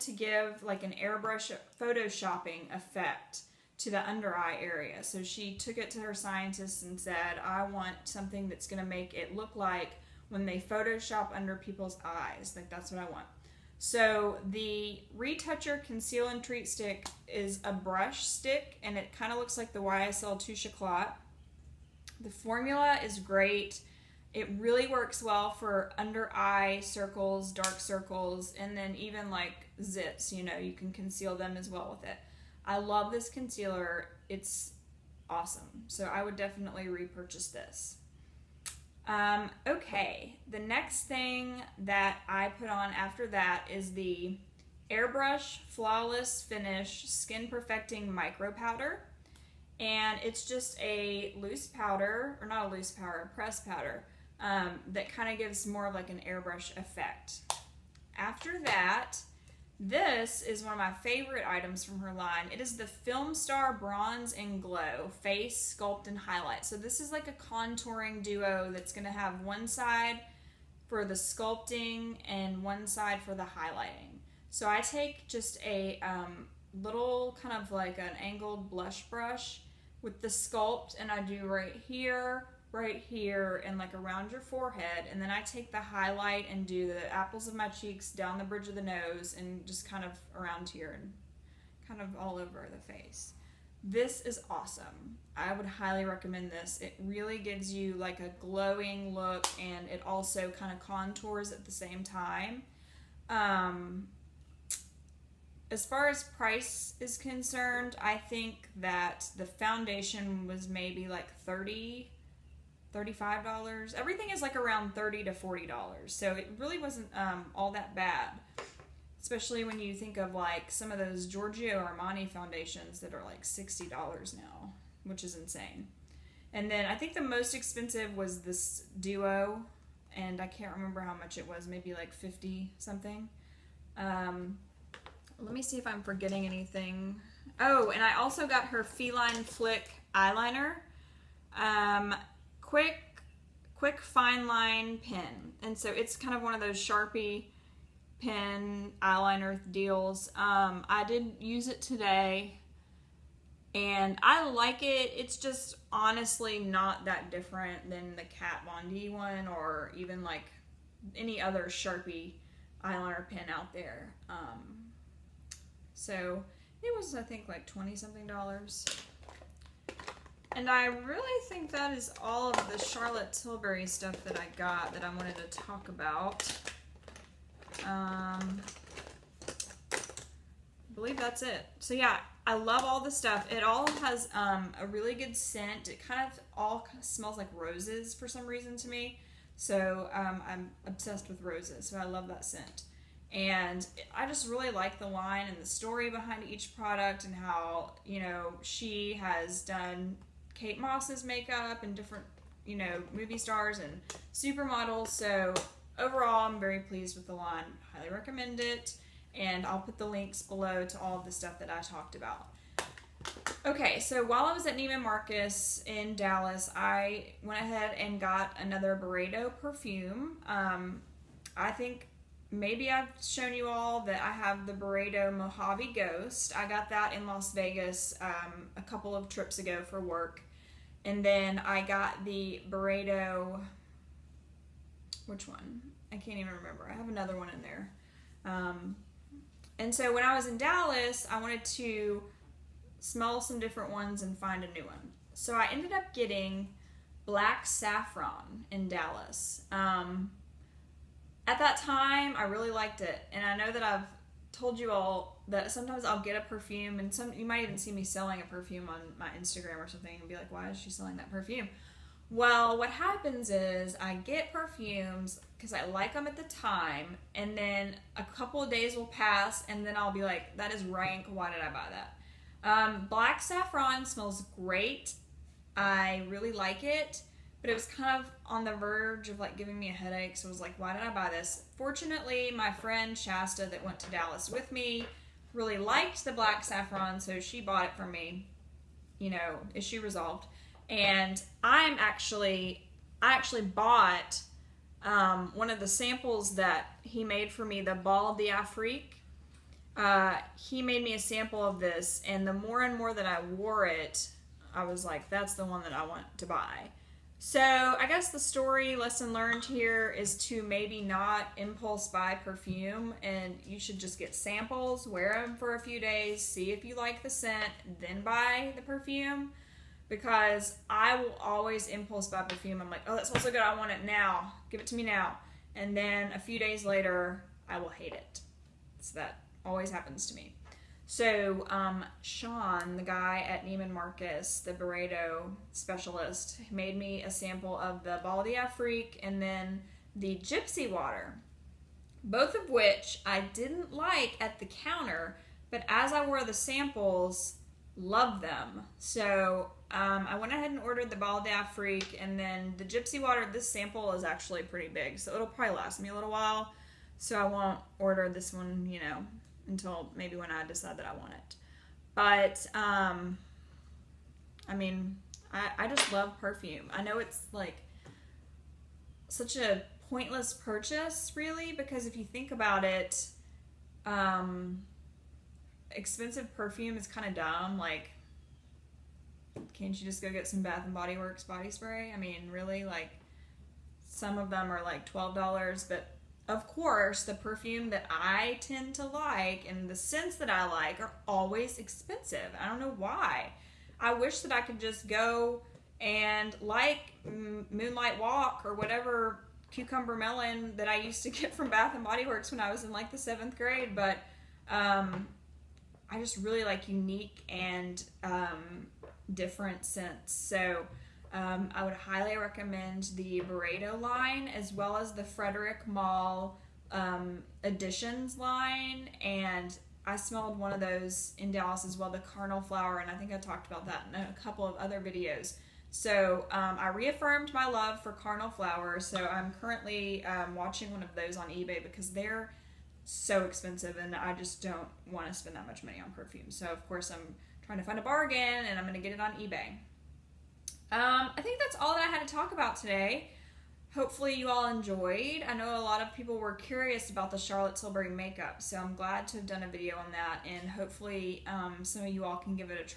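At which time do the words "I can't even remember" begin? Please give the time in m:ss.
3:56.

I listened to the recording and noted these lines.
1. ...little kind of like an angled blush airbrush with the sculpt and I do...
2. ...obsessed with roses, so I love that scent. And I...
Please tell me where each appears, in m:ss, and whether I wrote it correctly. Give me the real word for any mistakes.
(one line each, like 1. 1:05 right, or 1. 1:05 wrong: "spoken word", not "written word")
1. 1:16 wrong: "brush", not "airbrush"
2. 3:10 right.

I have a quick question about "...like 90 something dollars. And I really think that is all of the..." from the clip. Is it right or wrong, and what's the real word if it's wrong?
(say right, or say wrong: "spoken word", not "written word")
wrong: "20", not "90".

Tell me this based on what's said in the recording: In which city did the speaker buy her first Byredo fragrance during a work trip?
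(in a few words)
Las Vegas.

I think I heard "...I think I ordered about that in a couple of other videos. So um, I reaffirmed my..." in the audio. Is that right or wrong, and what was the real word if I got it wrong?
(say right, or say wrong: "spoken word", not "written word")
wrong: "talked", not "ordered".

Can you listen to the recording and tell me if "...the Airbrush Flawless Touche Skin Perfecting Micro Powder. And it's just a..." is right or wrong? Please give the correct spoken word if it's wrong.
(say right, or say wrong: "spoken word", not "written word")
wrong: "Finish", not "Touche".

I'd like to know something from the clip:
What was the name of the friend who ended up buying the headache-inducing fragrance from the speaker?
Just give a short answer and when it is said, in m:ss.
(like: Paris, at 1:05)
Shasta, at 4:43.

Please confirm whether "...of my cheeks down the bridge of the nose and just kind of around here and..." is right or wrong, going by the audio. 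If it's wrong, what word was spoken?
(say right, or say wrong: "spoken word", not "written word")
right.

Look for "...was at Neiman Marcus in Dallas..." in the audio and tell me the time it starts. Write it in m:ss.
3:34.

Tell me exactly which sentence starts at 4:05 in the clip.
So I ended up getting Black Saffron in Dallas.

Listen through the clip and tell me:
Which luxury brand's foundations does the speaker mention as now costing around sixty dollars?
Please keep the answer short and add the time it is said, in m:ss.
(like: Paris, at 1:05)
Giorgio Armani, at 2:01.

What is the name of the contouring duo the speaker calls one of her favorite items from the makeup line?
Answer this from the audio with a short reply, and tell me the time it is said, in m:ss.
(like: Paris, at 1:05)
Film Star Bronze and Glow, at 1:02.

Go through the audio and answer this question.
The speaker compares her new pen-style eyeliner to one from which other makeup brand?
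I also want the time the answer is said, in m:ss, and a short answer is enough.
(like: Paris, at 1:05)
Kat Von D, at 2:38.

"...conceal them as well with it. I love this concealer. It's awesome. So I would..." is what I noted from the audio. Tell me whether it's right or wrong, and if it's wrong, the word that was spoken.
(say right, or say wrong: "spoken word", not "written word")
right.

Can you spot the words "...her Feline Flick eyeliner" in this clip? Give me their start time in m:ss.
2:18.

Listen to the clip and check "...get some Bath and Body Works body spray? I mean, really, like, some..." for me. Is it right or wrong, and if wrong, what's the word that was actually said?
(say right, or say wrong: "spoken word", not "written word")
right.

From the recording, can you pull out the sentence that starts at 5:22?
I'm like, oh, that smells so good.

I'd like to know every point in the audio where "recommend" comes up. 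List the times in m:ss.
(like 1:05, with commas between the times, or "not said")
1:36, 3:28, 6:52.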